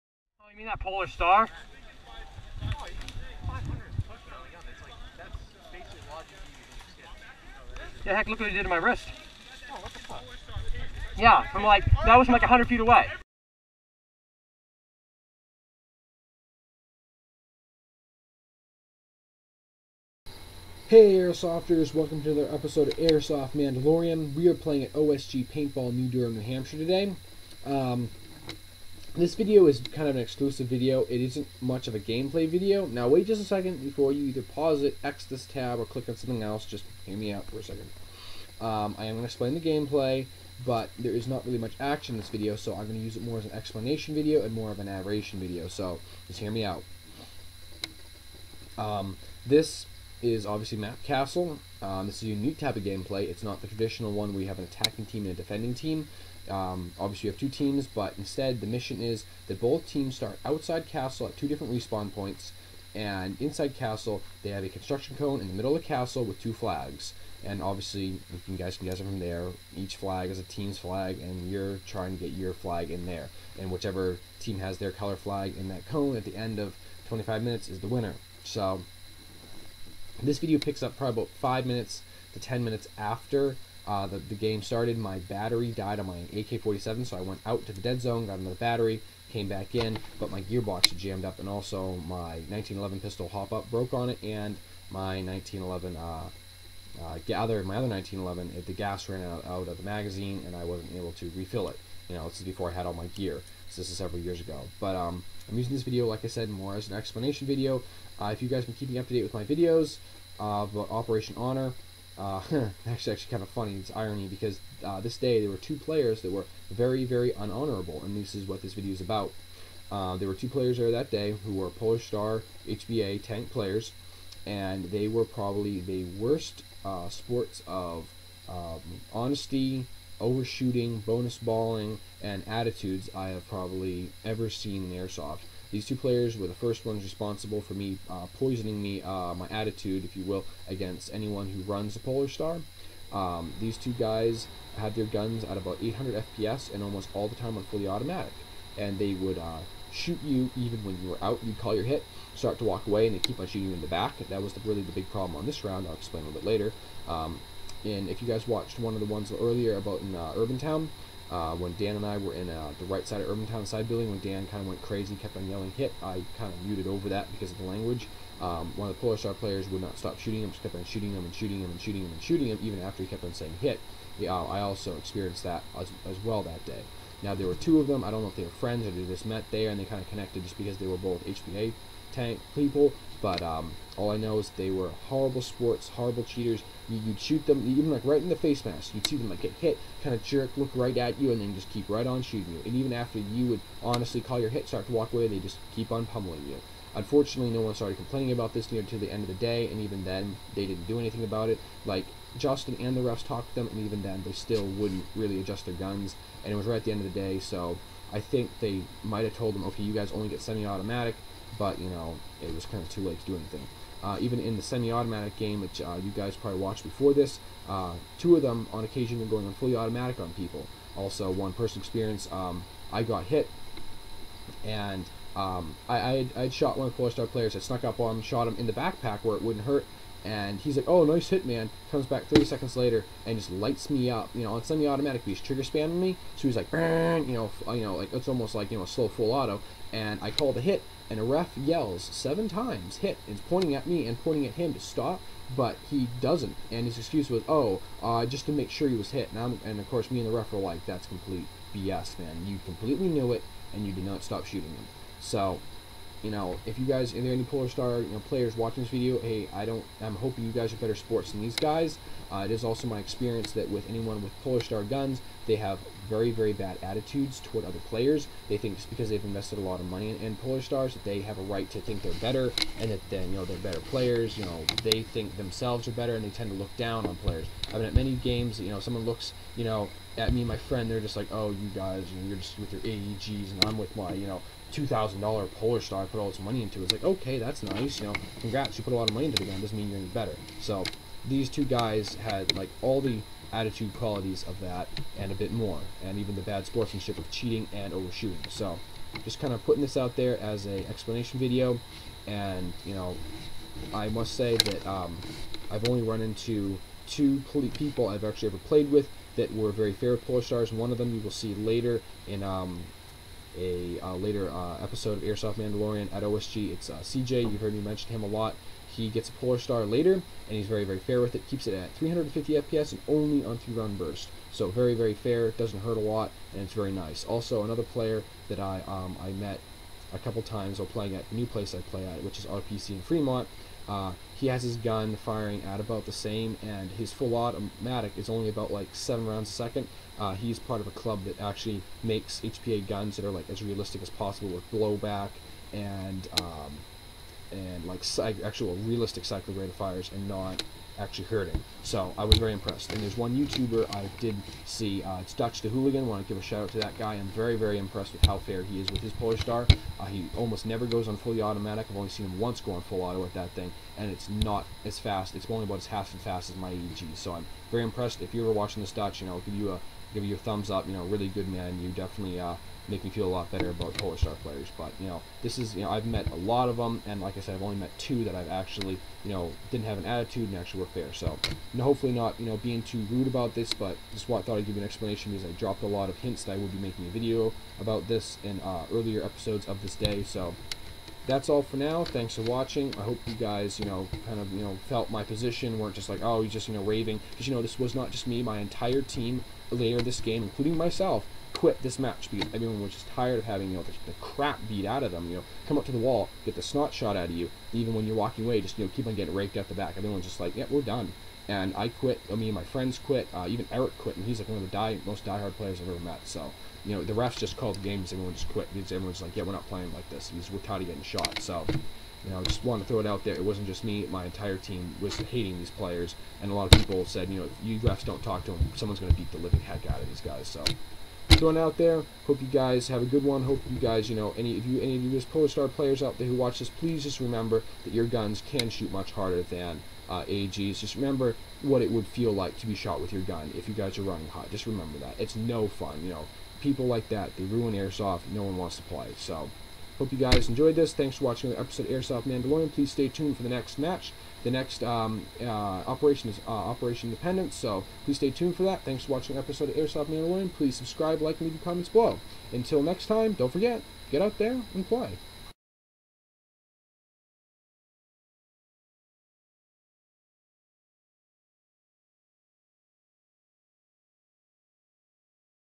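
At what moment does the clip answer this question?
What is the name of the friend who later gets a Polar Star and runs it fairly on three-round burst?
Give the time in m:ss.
5:17.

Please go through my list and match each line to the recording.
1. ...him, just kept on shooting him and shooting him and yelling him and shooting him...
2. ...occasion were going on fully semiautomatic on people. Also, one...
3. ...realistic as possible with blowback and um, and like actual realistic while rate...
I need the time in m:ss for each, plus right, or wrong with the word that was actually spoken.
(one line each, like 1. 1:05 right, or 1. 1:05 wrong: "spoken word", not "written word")
1. 2:50 wrong: "shooting", not "yelling"
2. 3:38 wrong: "automatic", not "semiautomatic"
3. 5:43 wrong: "cycle", not "while".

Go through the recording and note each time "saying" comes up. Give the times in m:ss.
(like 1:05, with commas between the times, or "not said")
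2:53.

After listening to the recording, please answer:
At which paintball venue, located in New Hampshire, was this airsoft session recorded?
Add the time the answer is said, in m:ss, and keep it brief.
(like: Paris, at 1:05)
OSG Paintball New Durham, at 0:24.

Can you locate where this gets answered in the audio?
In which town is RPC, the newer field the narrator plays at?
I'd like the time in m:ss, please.
5:33.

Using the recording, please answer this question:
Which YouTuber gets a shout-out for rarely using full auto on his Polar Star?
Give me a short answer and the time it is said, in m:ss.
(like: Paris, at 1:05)
Dutch the Hooligan, at 5:55.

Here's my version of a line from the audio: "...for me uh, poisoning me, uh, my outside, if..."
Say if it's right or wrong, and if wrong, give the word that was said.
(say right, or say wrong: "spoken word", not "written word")
wrong: "attitude", not "outside".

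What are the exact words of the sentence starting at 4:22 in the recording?
Uh, it is also my experience that with anyone with Polar Star guns, they have very, very bad attitudes toward other players.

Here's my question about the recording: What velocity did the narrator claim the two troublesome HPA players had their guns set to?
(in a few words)
800 FPS.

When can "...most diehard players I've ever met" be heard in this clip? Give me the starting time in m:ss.
6:55.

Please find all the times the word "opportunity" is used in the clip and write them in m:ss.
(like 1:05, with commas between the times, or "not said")
not said.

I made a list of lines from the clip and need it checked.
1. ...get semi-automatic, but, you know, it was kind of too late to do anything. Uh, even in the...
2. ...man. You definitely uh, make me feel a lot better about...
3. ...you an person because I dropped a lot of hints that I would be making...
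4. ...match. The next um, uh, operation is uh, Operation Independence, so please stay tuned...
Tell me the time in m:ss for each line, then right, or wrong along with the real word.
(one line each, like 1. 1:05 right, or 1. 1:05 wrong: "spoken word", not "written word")
1. 3:30 right
2. 6:11 right
3. 6:24 wrong: "explanation", not "person"
4. 7:33 right.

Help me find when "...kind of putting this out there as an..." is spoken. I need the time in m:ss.
4:59.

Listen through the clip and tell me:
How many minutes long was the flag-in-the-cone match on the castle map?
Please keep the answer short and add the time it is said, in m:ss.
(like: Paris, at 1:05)
25, at 1:17.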